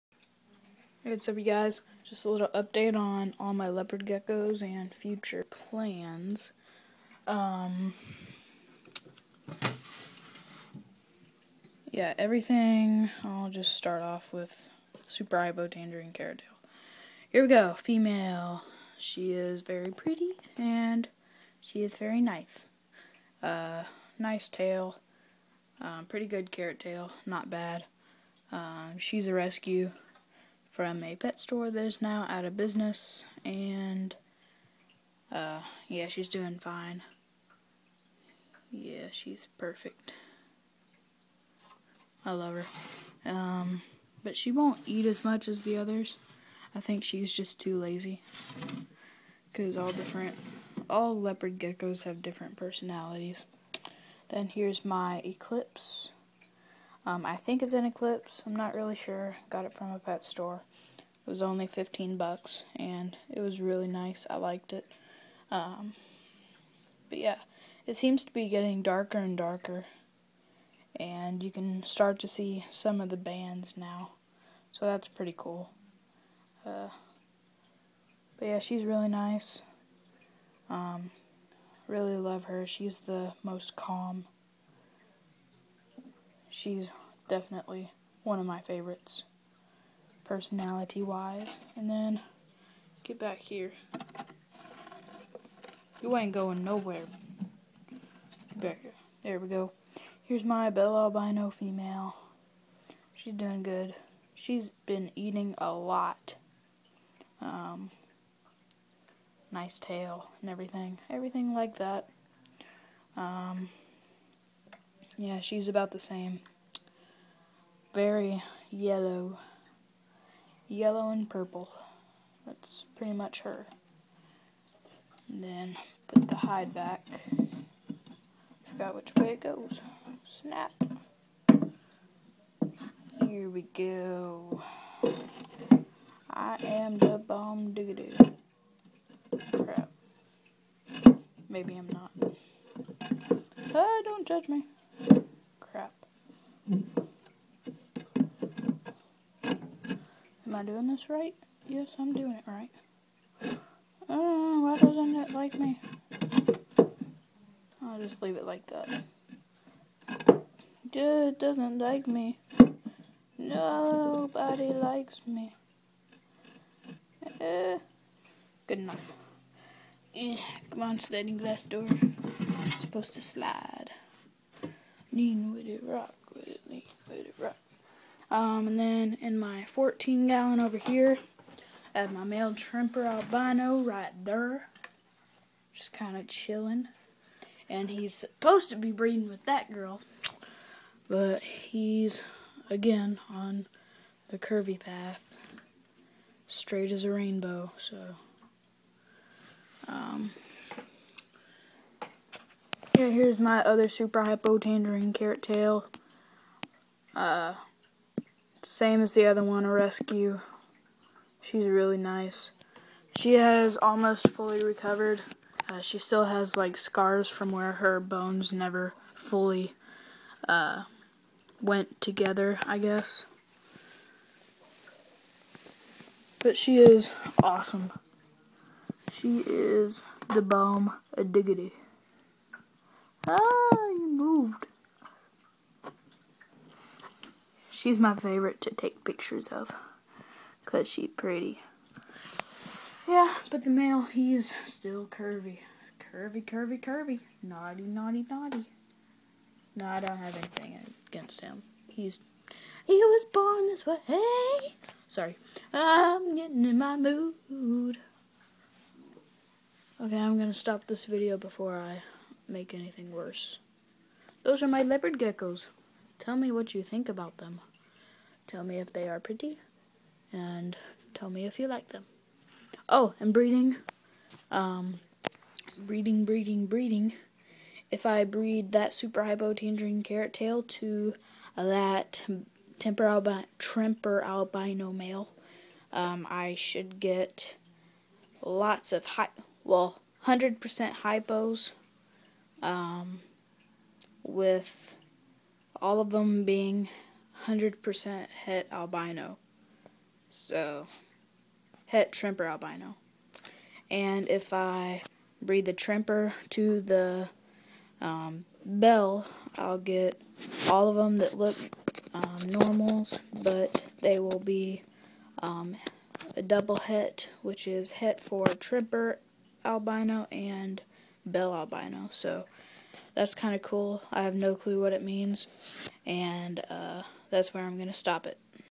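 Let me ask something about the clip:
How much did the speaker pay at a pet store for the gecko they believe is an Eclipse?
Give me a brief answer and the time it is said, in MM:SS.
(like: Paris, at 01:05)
$15, at 01:01.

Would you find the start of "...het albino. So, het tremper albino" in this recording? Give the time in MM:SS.
04:58.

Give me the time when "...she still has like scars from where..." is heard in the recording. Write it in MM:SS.
03:35.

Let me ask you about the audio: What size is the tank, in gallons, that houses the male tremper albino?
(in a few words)
14 gallon.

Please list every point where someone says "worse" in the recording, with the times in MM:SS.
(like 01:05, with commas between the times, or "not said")
04:23.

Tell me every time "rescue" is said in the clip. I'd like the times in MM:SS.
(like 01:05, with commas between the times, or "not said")
00:29, 03:29.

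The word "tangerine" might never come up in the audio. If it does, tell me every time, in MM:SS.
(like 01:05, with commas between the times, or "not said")
00:15, 03:24, 04:39.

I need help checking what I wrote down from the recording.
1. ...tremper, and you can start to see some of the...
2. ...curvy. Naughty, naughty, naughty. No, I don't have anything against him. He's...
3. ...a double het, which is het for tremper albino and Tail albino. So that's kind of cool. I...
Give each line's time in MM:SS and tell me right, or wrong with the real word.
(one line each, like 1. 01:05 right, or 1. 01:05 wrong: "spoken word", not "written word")
1. 01:09 wrong: "darker", not "tremper"
2. 04:06 right
3. 05:16 wrong: "Bell", not "Tail".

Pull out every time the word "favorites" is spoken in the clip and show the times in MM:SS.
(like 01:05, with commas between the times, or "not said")
01:28, 03:58.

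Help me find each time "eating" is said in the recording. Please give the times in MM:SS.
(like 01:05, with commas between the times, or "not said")
01:45.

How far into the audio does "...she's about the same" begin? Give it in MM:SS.
01:55.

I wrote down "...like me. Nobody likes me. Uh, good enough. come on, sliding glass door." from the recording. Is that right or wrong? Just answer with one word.
right.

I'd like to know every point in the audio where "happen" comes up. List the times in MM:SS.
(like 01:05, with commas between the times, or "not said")
not said.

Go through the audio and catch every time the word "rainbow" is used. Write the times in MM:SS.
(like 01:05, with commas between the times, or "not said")
03:17.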